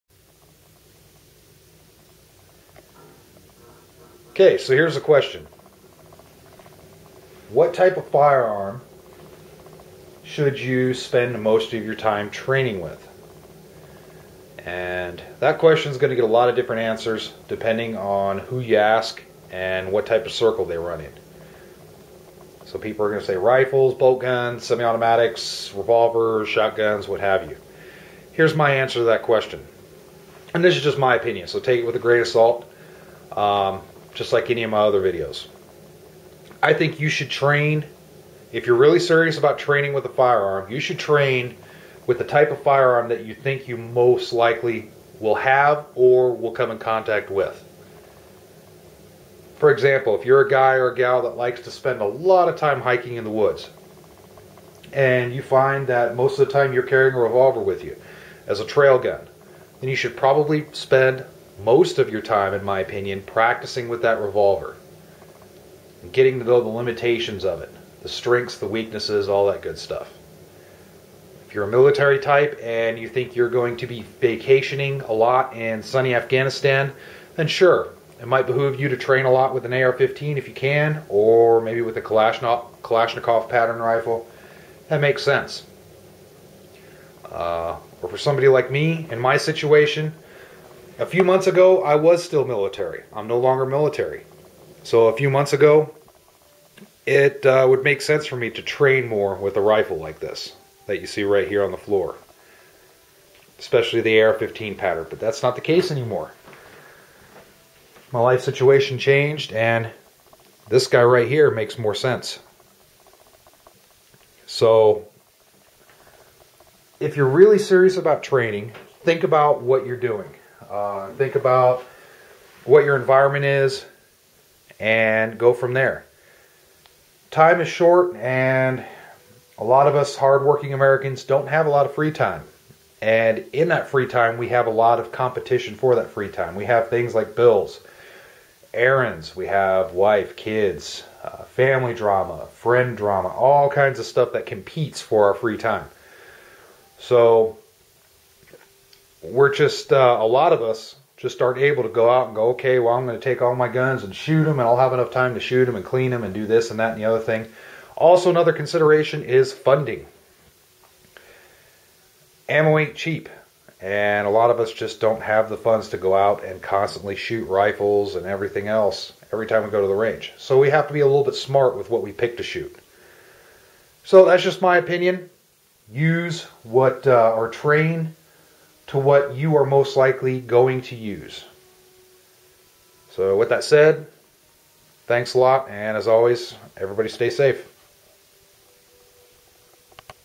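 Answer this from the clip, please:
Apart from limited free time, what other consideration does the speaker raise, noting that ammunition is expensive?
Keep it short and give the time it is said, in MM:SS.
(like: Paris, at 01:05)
Funding, at 02:39.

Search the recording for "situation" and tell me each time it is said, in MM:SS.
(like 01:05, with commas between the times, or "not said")
01:29, 01:48.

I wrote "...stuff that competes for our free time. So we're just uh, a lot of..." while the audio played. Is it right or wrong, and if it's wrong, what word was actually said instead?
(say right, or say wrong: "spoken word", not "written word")
right.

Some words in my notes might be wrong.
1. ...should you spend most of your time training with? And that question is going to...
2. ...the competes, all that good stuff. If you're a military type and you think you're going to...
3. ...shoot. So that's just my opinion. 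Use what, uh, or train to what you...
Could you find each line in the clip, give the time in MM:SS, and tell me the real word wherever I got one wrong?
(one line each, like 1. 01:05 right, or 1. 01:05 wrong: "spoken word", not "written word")
1. 00:10 right
2. 01:08 wrong: "weaknesses", not "competes"
3. 02:52 right.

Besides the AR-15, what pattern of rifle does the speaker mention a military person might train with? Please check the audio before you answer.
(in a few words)
Kalashnikov.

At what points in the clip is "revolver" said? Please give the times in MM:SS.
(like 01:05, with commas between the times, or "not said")
00:25, 00:57, 01:04.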